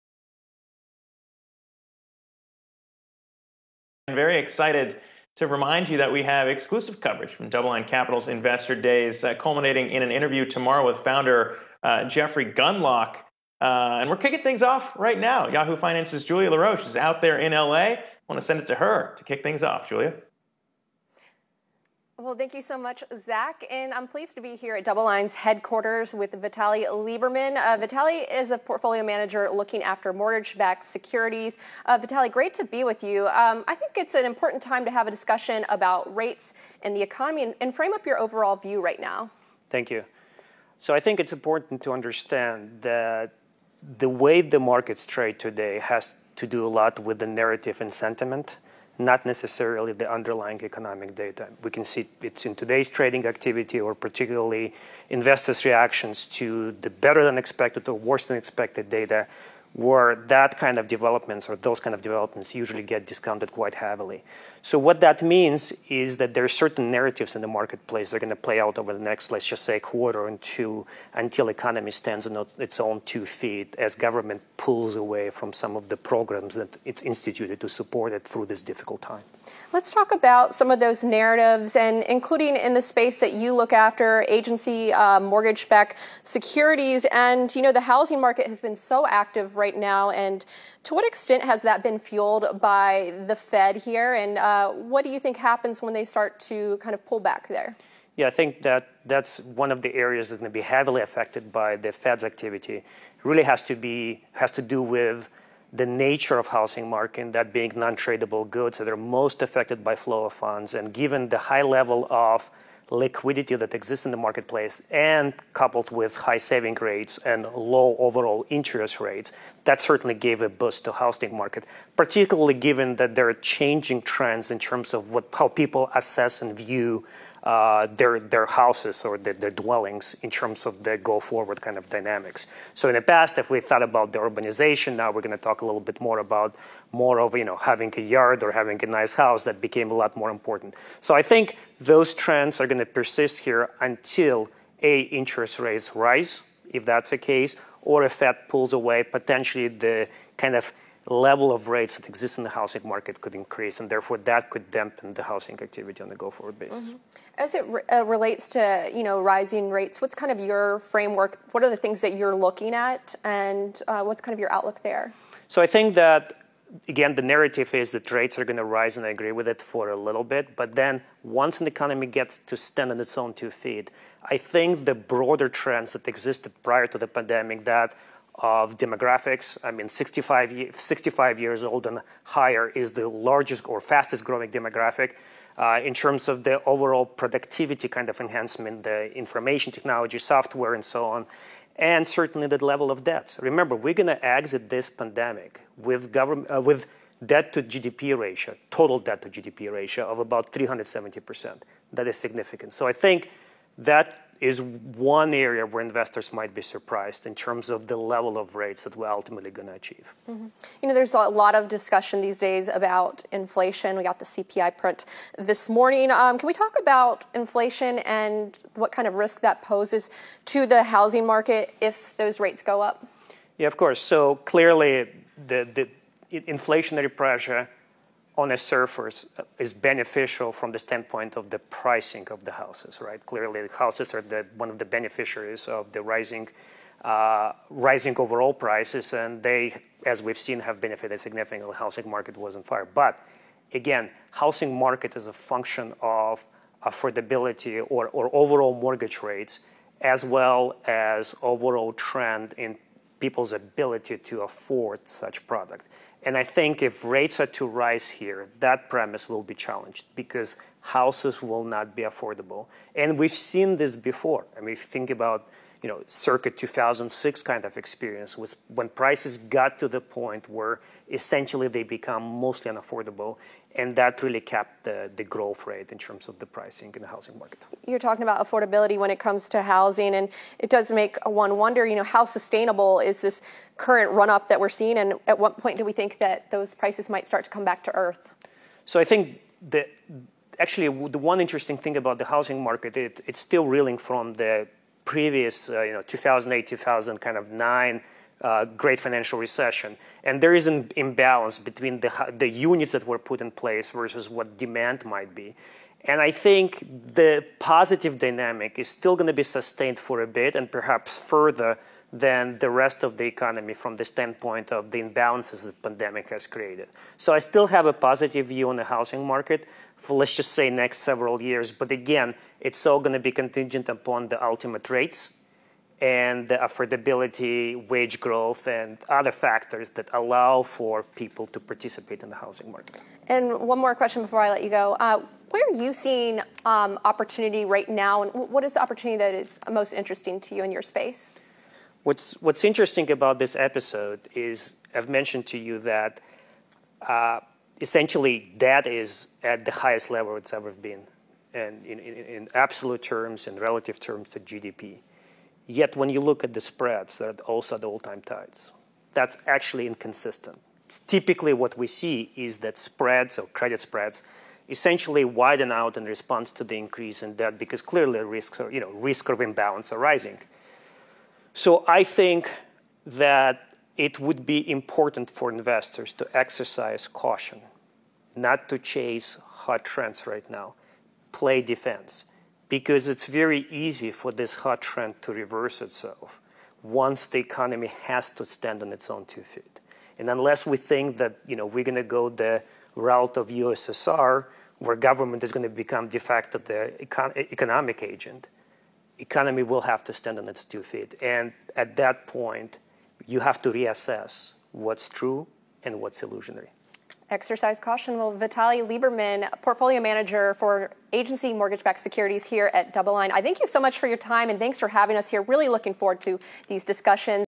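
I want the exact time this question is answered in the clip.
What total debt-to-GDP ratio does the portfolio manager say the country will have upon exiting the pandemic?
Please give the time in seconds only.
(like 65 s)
200 s.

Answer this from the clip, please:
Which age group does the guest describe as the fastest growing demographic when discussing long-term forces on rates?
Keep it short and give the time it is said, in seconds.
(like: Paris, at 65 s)
65 and older, at 180 s.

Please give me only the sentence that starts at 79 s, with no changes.
Let's talk about some of those narratives and including in the space that you look after agency uh, um, mortgage backed securities.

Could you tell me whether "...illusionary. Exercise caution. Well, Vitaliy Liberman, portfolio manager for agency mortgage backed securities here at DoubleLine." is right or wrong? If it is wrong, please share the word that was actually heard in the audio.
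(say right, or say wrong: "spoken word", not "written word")
right.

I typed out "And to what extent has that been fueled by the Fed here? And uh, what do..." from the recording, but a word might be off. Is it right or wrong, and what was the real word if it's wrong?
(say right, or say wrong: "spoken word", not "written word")
right.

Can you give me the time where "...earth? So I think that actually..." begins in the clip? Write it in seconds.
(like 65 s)
287 s.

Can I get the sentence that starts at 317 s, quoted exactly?
So I still have a positive view on the housing market for let's just say next several years.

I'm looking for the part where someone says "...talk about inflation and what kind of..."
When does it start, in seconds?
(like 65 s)
216 s.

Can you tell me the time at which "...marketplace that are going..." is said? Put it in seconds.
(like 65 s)
67 s.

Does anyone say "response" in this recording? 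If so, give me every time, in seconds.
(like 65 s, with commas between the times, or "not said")
366 s.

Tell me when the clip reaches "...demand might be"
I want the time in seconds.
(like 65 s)
304 s.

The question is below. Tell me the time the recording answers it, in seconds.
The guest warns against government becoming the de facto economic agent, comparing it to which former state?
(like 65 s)
393 s.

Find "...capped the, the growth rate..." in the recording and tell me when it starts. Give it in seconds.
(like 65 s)
274 s.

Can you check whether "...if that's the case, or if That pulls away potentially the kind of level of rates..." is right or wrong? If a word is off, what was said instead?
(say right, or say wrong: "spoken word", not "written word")
wrong: "Fed", not "That".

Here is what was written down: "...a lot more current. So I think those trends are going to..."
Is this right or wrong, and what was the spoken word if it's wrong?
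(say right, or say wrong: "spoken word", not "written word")
wrong: "important", not "current".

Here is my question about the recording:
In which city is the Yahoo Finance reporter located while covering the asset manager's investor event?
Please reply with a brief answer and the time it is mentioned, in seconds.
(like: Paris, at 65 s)
LA, at 17 s.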